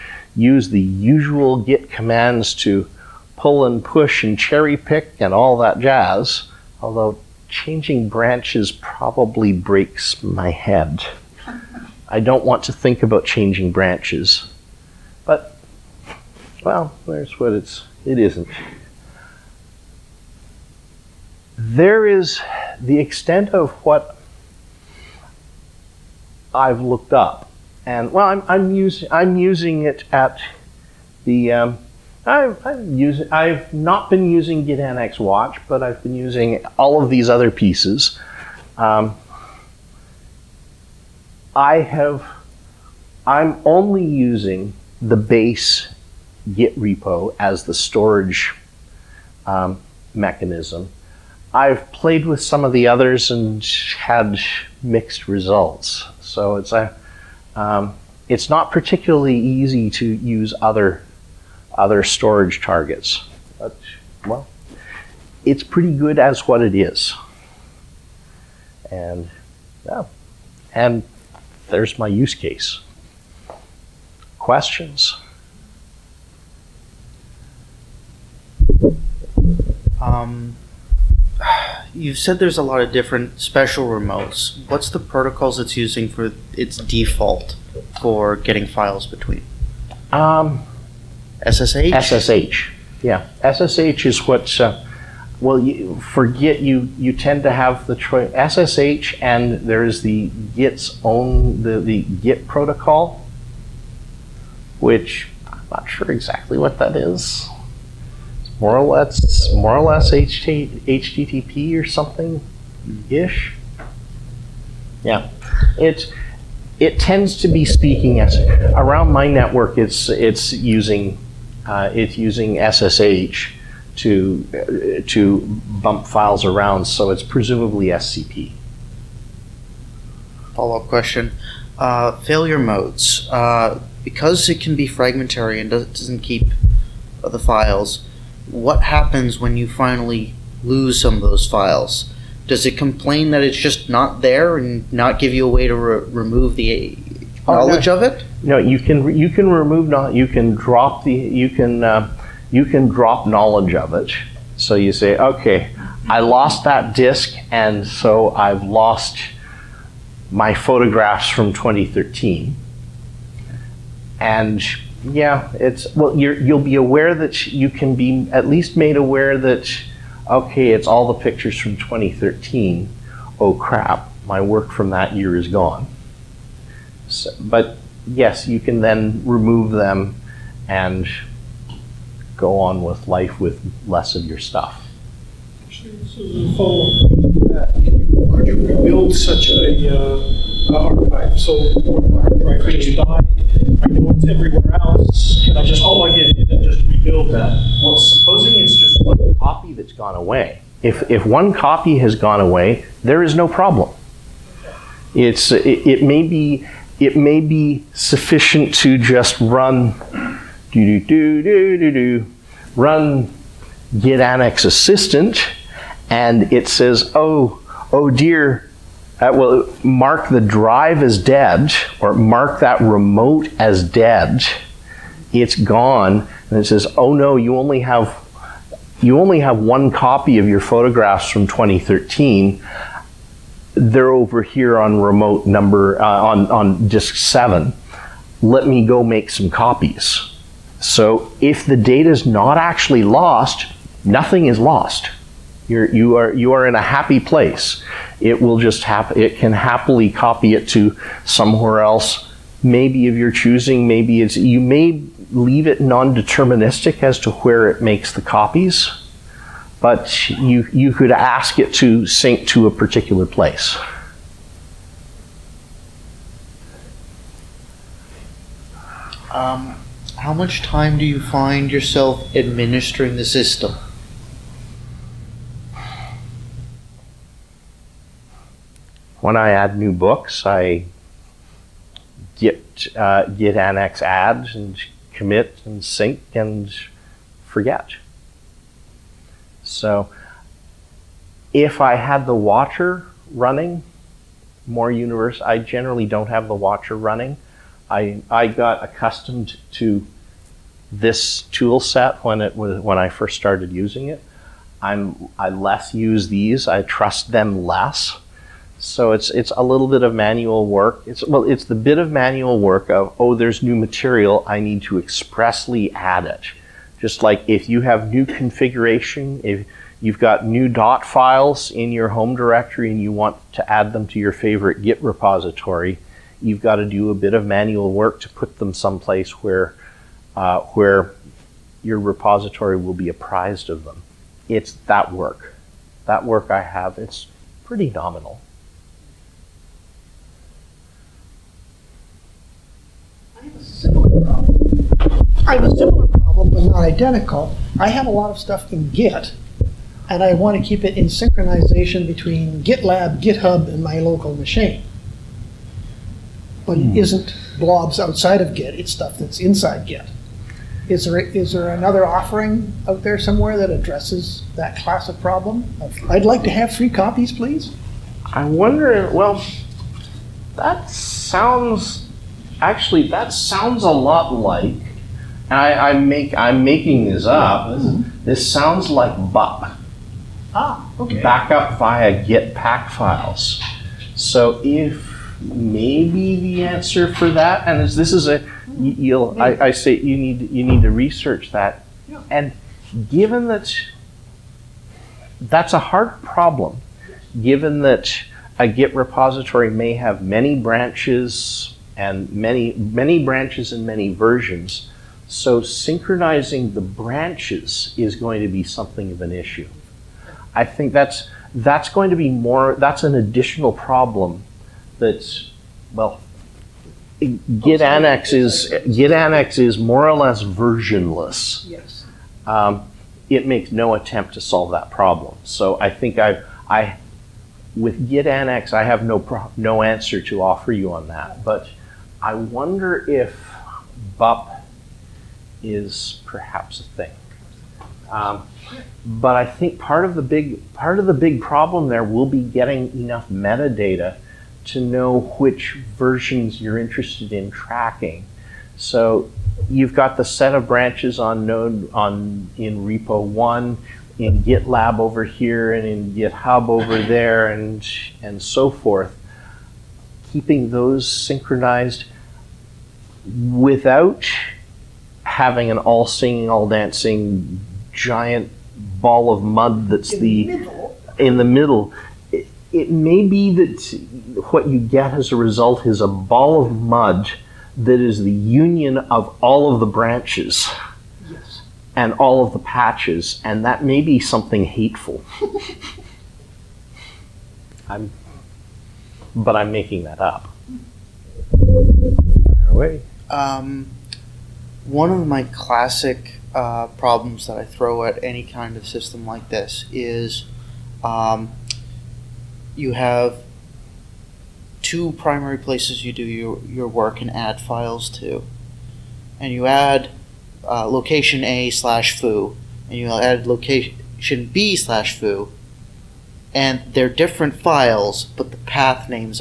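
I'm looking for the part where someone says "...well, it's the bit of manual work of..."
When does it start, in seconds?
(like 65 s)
311 s.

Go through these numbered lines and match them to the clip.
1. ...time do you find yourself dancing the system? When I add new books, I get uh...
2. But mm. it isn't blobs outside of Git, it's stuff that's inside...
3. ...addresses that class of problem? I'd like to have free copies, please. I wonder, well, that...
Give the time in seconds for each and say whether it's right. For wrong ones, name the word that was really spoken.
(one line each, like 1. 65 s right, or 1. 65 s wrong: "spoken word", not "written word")
1. 270 s wrong: "administering", not "dancing"
2. 356 s right
3. 363 s right.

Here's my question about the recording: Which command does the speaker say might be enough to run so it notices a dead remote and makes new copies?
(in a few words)
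git annex assistant.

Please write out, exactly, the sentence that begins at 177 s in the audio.
So, but yes, you can then remove them and go on with life with less of your stuff.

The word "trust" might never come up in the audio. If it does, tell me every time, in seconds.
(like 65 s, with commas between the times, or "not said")
306 s.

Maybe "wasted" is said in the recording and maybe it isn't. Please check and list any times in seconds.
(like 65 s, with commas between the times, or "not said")
not said.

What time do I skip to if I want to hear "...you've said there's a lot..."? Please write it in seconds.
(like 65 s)
81 s.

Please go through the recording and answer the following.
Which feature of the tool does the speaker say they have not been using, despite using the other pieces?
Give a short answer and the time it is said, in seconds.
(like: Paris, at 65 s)
Git Annex Watch, at 34 s.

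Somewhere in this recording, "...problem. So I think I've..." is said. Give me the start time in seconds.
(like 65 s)
424 s.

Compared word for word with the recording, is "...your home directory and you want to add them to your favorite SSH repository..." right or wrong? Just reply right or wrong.
wrong.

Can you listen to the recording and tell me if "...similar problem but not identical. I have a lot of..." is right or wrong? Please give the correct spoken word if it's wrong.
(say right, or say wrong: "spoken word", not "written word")
right.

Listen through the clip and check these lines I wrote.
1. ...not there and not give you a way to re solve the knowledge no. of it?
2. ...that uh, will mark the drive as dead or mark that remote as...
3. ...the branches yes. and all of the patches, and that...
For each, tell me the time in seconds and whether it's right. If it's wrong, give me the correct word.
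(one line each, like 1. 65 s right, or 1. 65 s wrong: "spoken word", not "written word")
1. 143 s wrong: "remove", not "solve"
2. 219 s right
3. 479 s right.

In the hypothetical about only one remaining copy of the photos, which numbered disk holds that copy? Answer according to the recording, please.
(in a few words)
disk seven.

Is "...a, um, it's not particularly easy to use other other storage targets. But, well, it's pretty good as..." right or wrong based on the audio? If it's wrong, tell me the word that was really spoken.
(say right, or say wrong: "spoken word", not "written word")
right.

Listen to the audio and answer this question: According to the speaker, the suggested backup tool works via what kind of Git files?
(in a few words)
pack files.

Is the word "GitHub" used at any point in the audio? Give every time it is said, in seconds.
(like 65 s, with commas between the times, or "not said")
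353 s, 456 s.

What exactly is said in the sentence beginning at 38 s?
Um, I have, I'm only using the base Git repo as the storage um, mechanism.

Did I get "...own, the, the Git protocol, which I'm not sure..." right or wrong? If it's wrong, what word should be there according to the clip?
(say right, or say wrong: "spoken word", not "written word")
right.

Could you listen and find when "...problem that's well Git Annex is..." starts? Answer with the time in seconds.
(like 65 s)
413 s.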